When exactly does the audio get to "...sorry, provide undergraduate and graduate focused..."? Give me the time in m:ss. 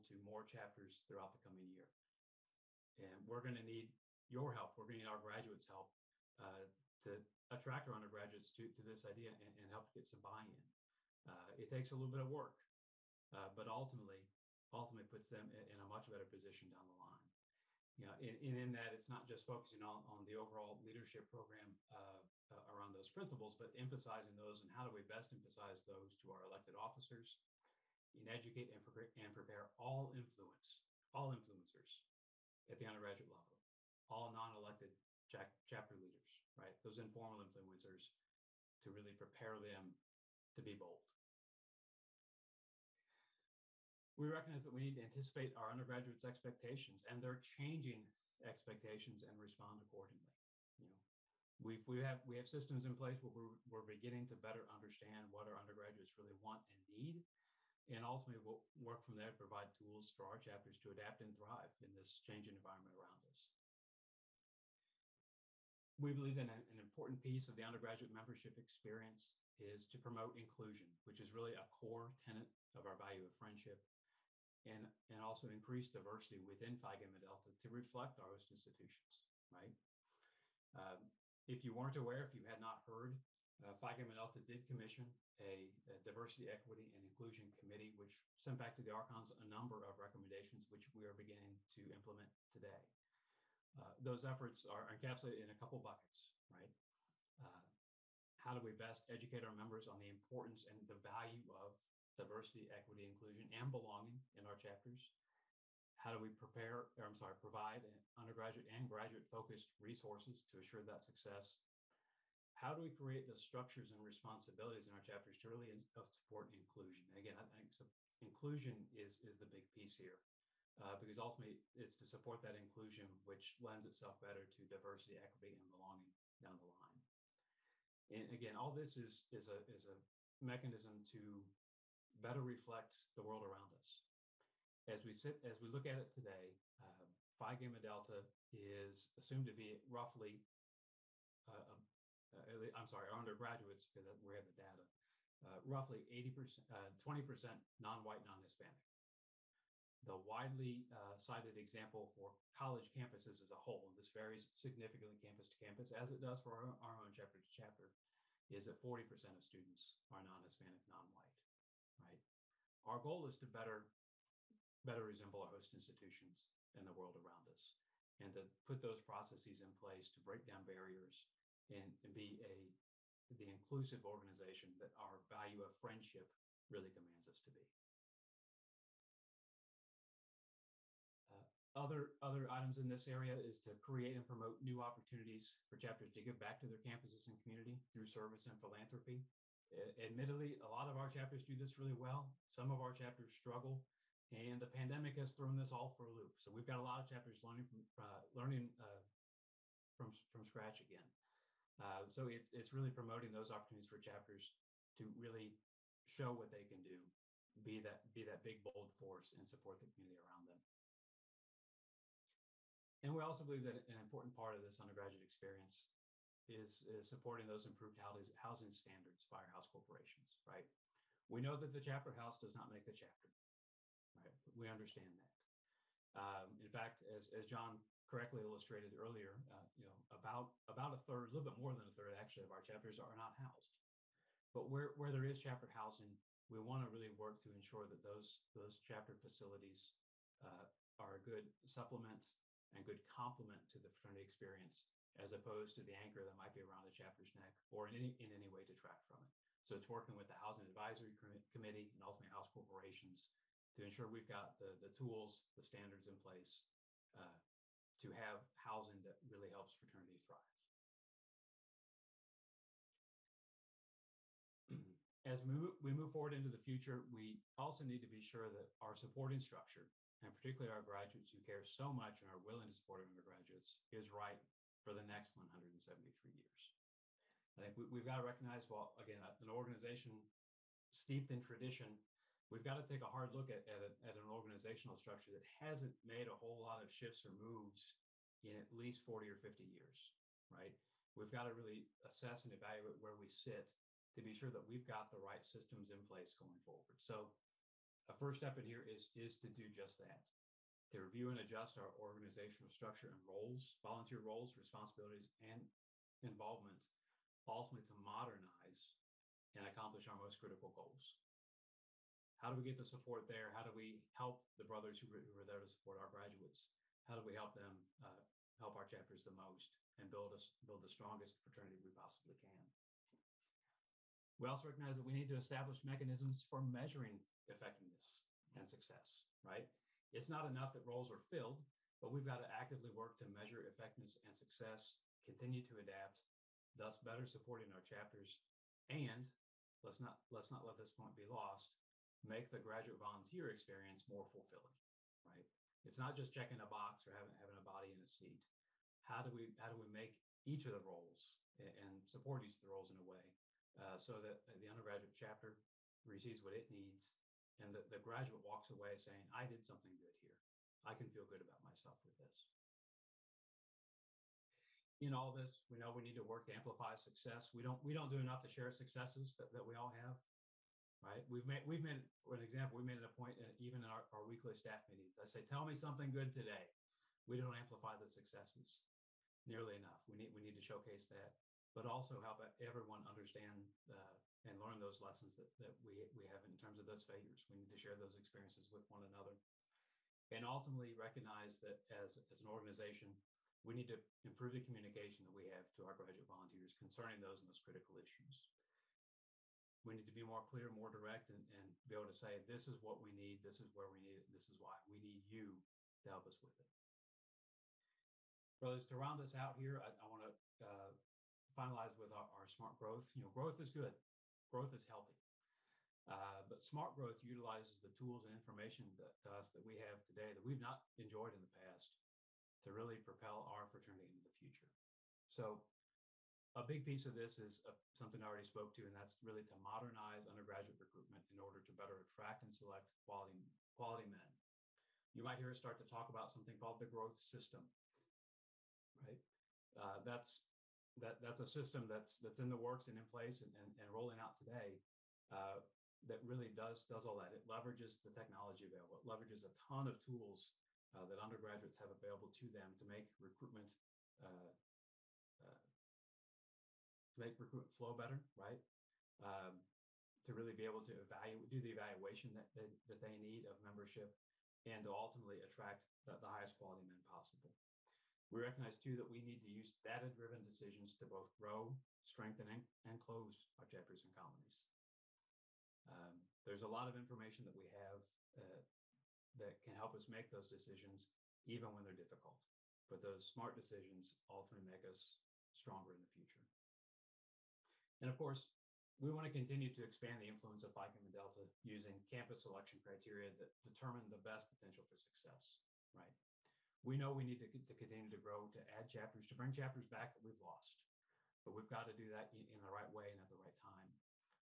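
1:47.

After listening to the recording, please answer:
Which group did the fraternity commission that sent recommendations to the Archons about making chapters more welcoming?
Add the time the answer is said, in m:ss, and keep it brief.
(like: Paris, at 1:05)
diversity, equity, and inclusion committee, at 1:25.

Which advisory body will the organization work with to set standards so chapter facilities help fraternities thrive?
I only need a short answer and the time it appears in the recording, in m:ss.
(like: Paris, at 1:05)
Housing Advisory Committee, at 4:10.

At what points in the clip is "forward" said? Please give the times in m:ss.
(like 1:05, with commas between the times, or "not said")
4:26, 4:56.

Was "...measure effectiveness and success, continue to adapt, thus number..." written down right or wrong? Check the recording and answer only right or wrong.
wrong.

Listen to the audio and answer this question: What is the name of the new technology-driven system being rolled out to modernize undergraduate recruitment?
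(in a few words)
growth system.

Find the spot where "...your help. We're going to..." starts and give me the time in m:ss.
0:04.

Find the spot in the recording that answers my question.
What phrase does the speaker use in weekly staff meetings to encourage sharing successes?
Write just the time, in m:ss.
6:15.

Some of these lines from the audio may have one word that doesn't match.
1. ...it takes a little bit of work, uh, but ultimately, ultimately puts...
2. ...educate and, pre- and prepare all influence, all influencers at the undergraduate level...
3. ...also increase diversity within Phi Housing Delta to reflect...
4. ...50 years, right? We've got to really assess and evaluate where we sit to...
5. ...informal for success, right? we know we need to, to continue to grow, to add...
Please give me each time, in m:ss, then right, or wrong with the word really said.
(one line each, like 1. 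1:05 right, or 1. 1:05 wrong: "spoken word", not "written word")
1. 0:11 right
2. 0:28 right
3. 1:15 wrong: "Gamma", not "Housing"
4. 4:49 right
5. 8:14 wrong: "potential", not "informal".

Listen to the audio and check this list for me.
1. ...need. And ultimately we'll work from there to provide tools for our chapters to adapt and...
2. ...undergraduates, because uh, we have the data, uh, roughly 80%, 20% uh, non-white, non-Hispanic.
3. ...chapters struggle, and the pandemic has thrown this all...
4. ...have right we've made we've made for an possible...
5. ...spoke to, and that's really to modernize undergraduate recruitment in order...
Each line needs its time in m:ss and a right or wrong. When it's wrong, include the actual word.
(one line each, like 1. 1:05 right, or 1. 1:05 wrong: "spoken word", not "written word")
1. 0:56 right
2. 2:23 right
3. 3:12 right
4. 6:09 wrong: "example", not "possible"
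5. 7:08 right.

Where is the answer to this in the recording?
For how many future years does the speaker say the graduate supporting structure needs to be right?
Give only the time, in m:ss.
4:35.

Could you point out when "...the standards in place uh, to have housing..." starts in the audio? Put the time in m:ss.
4:15.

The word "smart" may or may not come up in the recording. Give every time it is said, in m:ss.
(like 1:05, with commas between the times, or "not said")
6:52, 6:56, 8:03.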